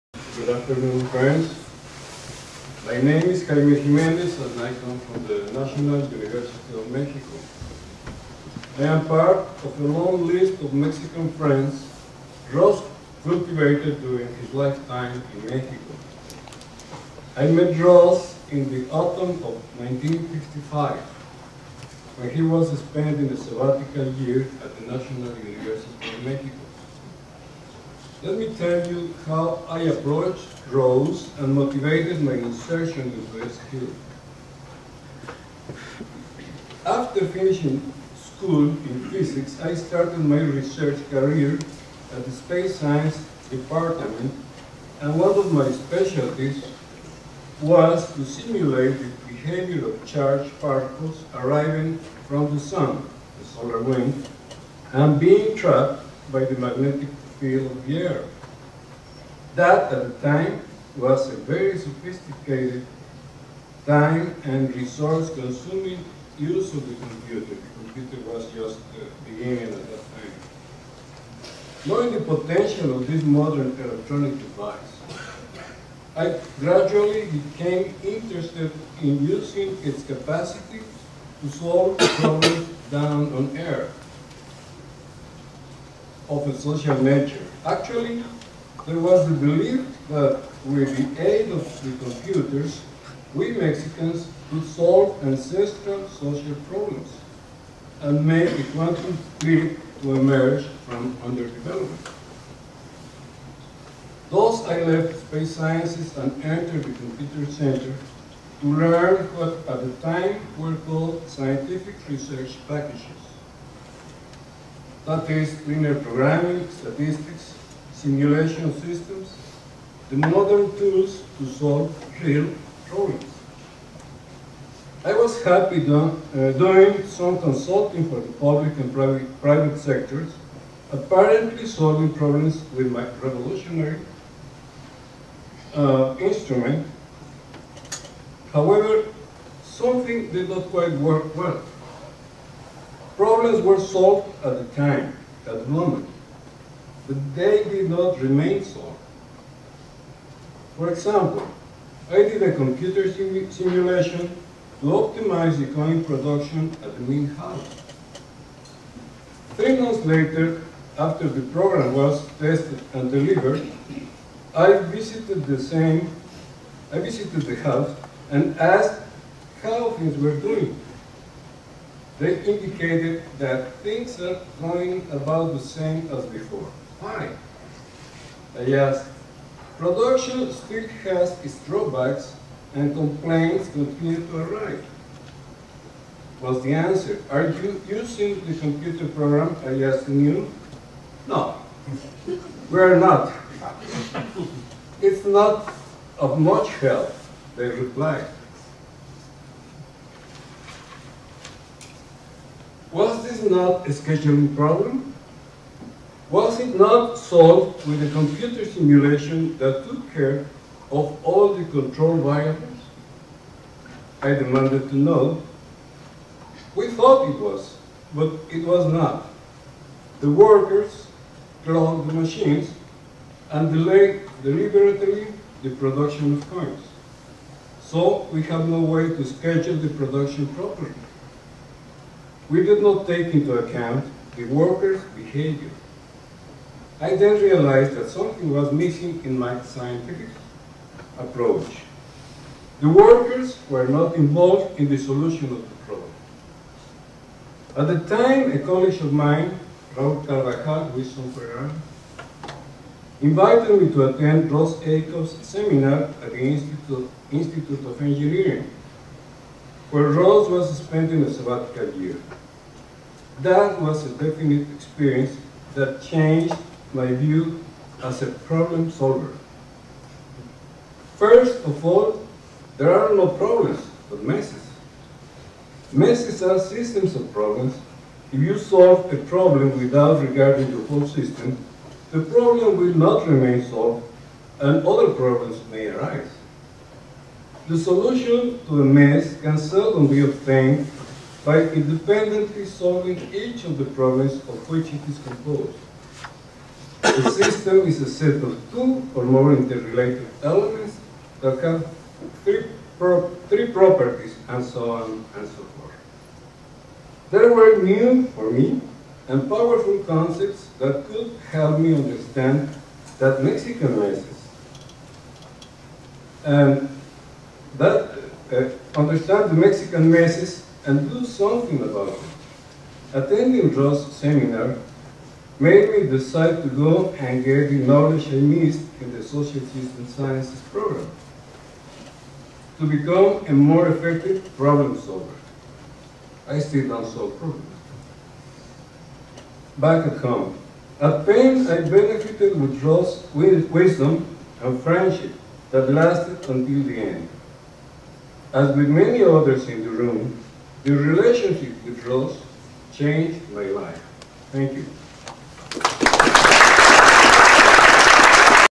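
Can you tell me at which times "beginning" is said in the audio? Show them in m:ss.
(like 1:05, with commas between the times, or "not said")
1:09.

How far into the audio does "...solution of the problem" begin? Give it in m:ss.
4:04.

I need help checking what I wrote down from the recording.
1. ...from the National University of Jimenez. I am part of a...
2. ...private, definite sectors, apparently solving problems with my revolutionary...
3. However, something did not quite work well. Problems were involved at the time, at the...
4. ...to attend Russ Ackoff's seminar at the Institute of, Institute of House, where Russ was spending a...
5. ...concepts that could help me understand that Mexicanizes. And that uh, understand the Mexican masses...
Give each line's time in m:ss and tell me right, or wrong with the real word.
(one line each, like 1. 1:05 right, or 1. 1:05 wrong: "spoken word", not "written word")
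1. 0:05 wrong: "Mexico", not "Jimenez"
2. 2:08 wrong: "private", not "definite"
3. 2:18 wrong: "solved", not "involved"
4. 4:13 wrong: "Engineering", not "House"
5. 5:10 right.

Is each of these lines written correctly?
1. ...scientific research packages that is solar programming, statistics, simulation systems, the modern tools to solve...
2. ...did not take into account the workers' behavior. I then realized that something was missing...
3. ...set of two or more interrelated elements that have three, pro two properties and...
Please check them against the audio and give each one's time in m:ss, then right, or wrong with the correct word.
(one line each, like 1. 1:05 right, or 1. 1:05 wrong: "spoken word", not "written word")
1. 1:51 wrong: "linear", not "solar"
2. 3:52 right
3. 4:58 wrong: "three", not "two".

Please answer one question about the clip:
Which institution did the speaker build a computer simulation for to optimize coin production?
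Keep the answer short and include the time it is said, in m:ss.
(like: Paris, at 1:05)
Mint House, at 2:37.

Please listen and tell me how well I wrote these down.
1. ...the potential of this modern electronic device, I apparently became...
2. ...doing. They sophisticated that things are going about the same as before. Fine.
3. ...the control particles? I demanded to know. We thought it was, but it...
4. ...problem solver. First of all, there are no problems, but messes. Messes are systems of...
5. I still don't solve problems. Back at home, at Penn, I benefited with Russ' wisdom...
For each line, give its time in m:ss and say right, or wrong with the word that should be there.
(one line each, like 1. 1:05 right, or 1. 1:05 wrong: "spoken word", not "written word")
1. 1:12 wrong: "gradually", not "apparently"
2. 2:50 wrong: "indicated", not "sophisticated"
3. 3:31 wrong: "variables", not "particles"
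4. 4:28 right
5. 5:36 right.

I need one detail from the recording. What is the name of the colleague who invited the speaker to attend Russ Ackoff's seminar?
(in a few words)
Raul Carvajal.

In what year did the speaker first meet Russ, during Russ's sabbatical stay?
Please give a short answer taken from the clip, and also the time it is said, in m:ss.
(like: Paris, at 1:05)
1955, at 0:19.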